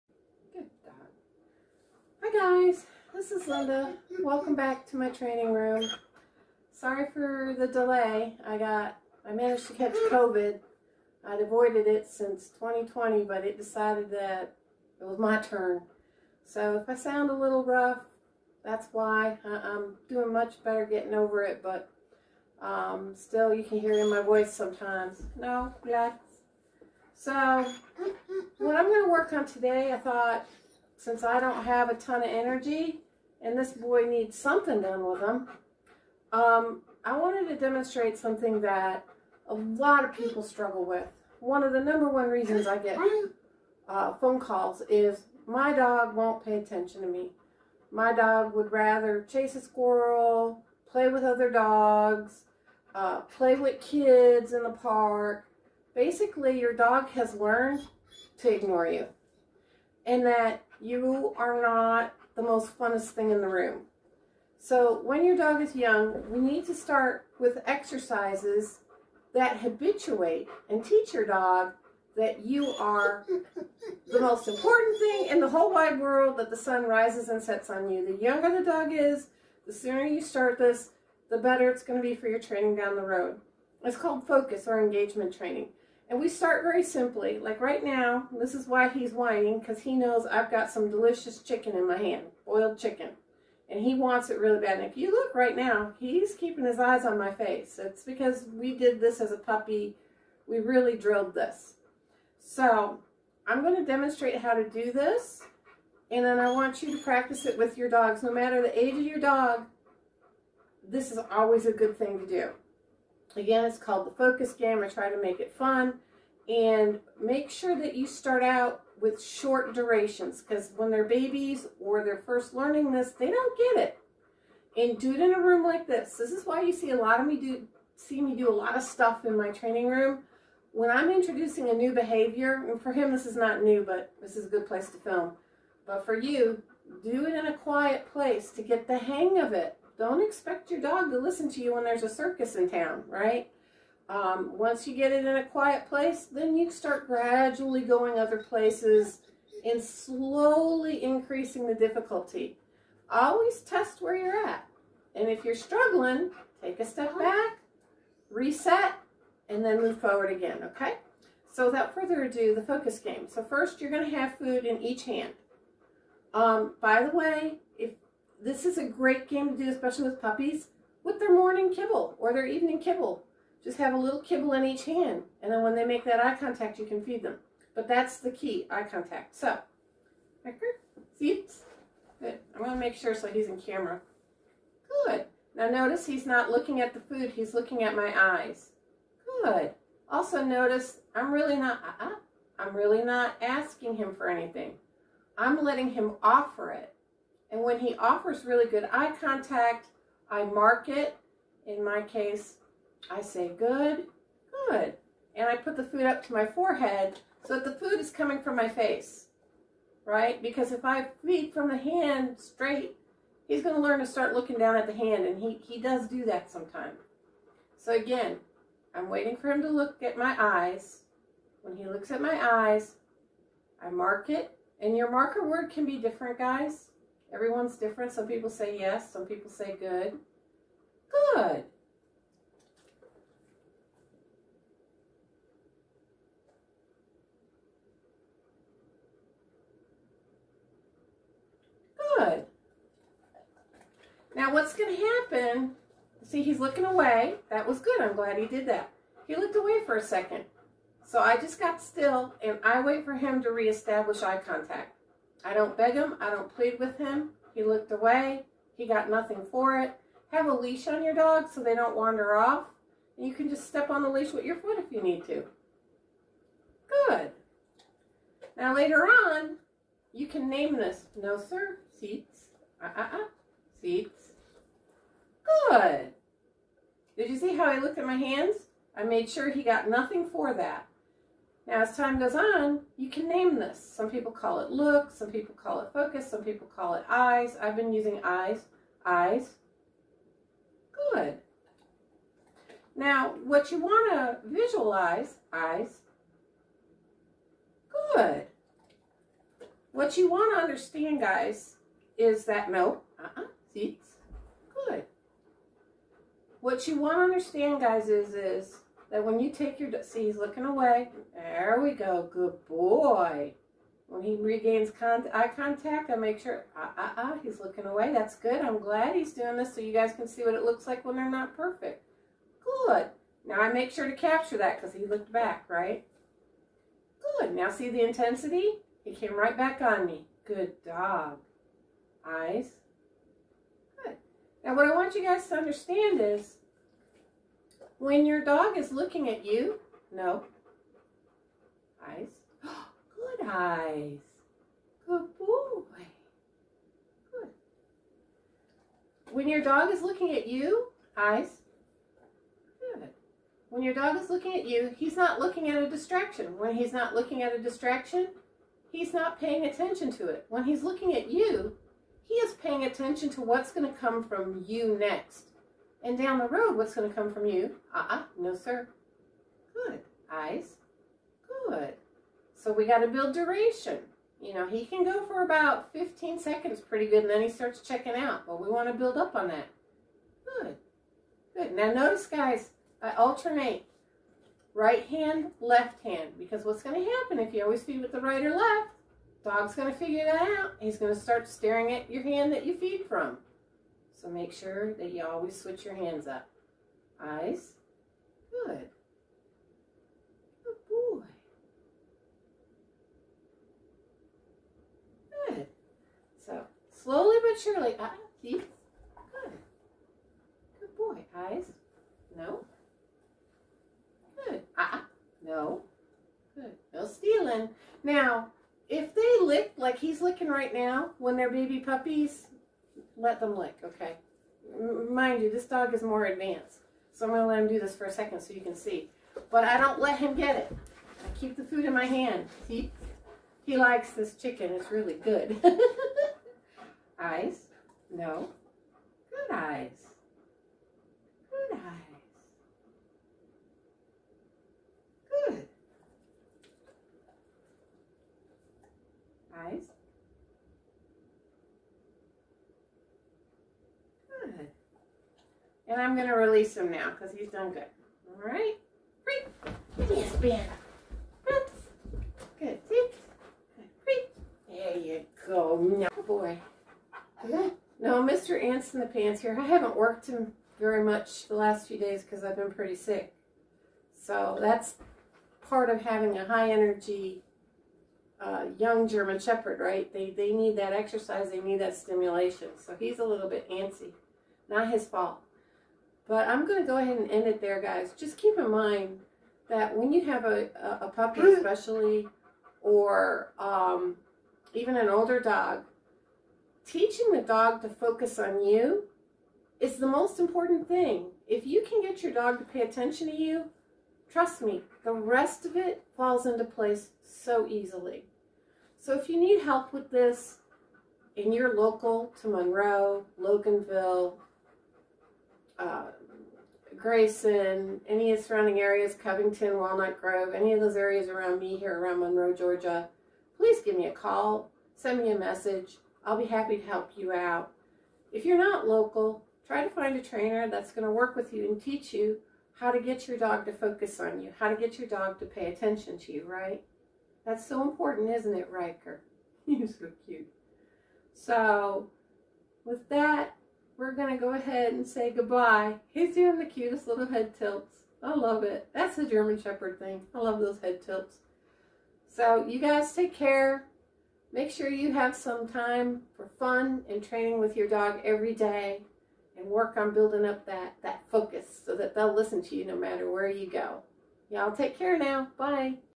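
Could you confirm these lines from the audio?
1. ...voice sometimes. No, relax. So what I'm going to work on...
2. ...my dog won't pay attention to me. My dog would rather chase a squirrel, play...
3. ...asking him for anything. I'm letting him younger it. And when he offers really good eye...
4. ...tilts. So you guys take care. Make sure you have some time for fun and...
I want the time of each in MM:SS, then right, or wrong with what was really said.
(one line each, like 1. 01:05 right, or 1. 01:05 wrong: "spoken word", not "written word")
1. 00:24 right
2. 00:45 right
3. 03:13 wrong: "offer", not "younger"
4. 09:11 right.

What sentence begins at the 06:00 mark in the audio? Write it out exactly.
When he's looking at you, he is paying attention to what's going to come from you next.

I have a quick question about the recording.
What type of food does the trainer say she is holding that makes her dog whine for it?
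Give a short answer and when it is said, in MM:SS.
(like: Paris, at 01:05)
Boiled chicken, at 01:32.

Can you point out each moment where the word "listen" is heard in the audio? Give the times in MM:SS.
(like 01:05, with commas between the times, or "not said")
02:21, 09:22.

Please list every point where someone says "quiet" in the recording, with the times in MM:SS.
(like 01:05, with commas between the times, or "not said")
02:17, 02:25.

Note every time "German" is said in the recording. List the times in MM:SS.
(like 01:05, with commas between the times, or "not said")
07:59, 09:09.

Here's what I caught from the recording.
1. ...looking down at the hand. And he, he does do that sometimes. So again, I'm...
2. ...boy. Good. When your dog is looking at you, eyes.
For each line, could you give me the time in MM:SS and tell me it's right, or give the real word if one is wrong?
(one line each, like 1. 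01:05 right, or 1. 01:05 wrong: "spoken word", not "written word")
1. 03:34 right
2. 05:45 right.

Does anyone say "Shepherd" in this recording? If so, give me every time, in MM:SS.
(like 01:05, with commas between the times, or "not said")
07:59, 09:09.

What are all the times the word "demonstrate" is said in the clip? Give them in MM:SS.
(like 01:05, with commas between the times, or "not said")
00:37, 01:43.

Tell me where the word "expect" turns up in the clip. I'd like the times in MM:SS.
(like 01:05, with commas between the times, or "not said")
02:20.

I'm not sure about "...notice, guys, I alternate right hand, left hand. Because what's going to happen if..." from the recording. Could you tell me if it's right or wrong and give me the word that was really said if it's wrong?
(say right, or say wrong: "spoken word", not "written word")
right.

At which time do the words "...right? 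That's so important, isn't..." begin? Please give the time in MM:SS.
08:56.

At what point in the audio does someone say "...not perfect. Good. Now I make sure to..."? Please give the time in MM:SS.
05:21.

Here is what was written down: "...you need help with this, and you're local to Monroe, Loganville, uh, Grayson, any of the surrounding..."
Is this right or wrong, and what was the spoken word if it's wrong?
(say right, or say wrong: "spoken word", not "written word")
right.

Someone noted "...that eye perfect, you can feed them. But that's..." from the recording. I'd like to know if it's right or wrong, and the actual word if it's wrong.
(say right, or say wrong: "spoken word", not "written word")
wrong: "contact", not "perfect".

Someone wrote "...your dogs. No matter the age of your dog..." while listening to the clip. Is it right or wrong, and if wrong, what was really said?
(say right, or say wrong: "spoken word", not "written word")
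right.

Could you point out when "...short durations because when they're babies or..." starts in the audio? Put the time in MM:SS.
01:59.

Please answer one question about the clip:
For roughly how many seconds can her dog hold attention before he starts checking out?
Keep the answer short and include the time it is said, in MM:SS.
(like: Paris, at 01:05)
15, at 06:15.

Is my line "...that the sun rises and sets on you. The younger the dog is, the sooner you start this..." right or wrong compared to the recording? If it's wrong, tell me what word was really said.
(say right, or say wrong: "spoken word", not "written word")
right.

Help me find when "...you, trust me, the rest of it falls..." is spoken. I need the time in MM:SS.
08:23.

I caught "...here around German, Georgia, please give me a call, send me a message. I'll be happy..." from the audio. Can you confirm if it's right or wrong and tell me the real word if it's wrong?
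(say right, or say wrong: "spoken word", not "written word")
wrong: "Monroe", not "German".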